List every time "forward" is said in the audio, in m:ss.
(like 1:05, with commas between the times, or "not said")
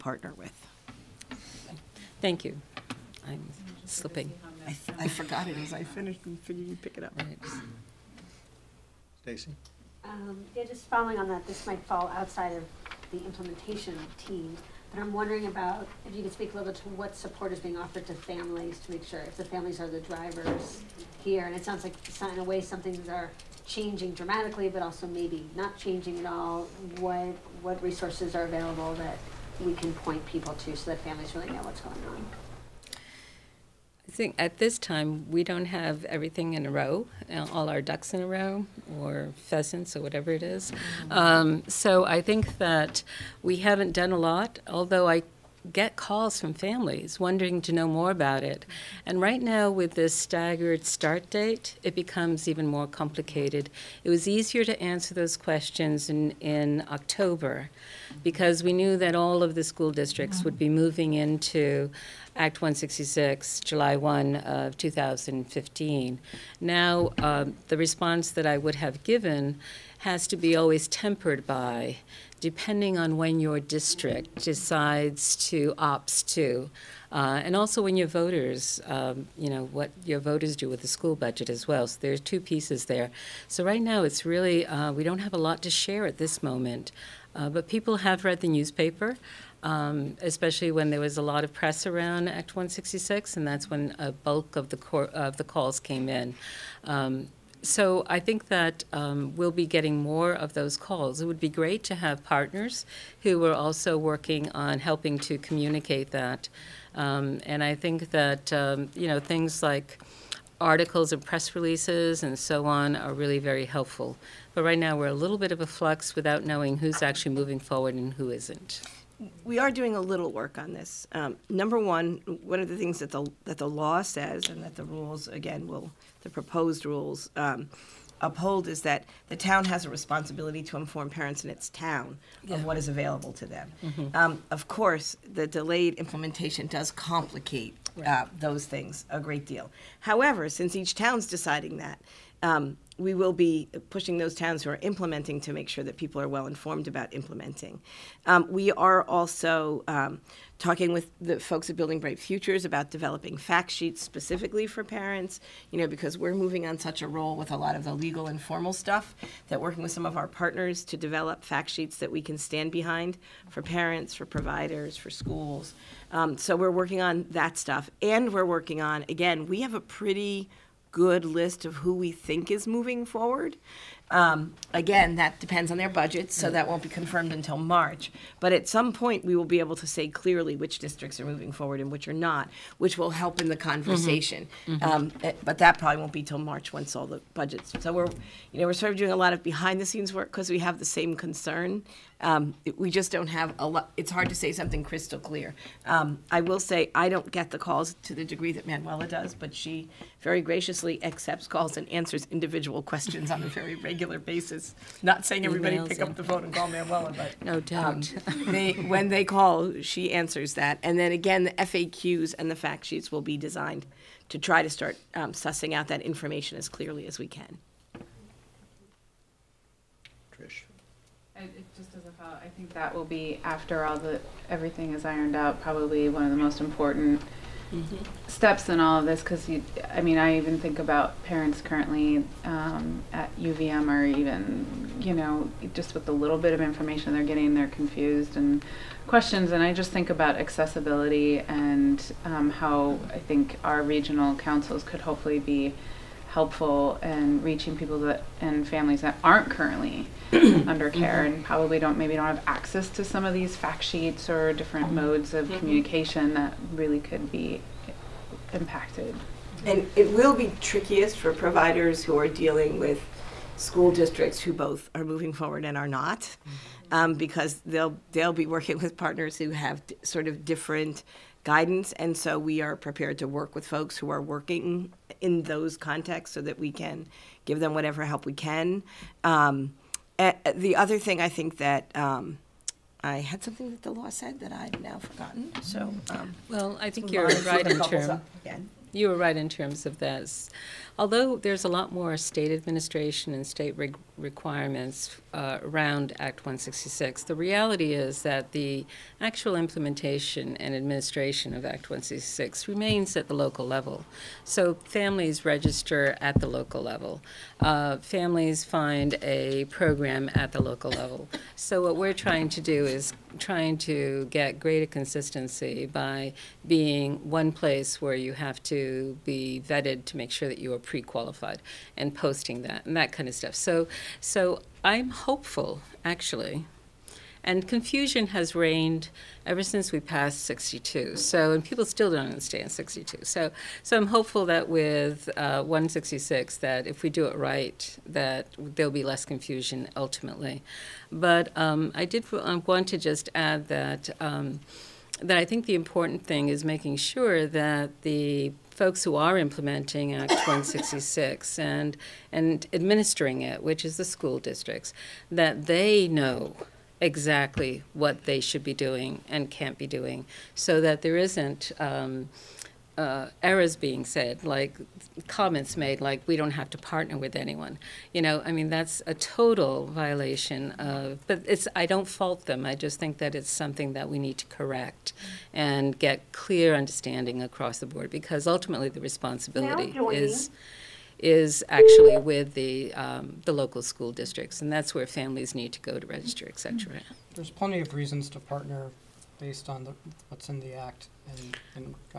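1:57, 2:53, 3:01, 4:25.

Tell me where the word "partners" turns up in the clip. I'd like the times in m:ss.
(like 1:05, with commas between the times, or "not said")
1:42, 2:40, 4:28, 6:06, 6:28.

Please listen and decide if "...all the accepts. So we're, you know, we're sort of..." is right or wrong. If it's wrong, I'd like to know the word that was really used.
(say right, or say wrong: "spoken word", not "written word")
wrong: "budgets", not "accepts".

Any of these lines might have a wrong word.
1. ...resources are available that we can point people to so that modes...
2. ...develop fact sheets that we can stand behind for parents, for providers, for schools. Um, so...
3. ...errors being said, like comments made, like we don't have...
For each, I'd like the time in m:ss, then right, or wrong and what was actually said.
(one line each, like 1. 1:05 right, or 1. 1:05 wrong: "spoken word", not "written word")
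1. 0:27 wrong: "families", not "modes"
2. 2:40 right
3. 6:03 right.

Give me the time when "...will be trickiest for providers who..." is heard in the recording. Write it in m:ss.
4:20.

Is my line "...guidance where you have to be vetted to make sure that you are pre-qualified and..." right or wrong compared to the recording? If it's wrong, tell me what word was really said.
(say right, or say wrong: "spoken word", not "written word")
wrong: "place", not "guidance".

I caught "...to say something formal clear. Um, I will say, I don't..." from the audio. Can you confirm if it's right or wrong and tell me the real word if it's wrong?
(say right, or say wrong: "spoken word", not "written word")
wrong: "crystal", not "formal".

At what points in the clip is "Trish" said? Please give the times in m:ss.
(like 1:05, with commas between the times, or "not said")
3:40.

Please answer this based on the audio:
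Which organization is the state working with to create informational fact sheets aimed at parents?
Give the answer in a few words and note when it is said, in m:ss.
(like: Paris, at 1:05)
Building Bright Futures, at 2:31.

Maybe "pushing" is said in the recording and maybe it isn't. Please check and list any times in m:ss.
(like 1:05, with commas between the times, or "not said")
2:23.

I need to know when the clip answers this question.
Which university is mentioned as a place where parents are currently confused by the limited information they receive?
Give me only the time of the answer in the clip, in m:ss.
3:53.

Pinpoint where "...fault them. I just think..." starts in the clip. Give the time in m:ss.
6:12.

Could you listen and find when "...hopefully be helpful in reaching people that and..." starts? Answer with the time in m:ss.
4:05.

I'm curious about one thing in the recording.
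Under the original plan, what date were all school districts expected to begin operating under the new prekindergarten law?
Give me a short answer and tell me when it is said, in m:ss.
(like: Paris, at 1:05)
July 1, 2015, at 1:03.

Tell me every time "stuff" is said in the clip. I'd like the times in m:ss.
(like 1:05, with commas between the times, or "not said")
2:38, 2:47, 5:23.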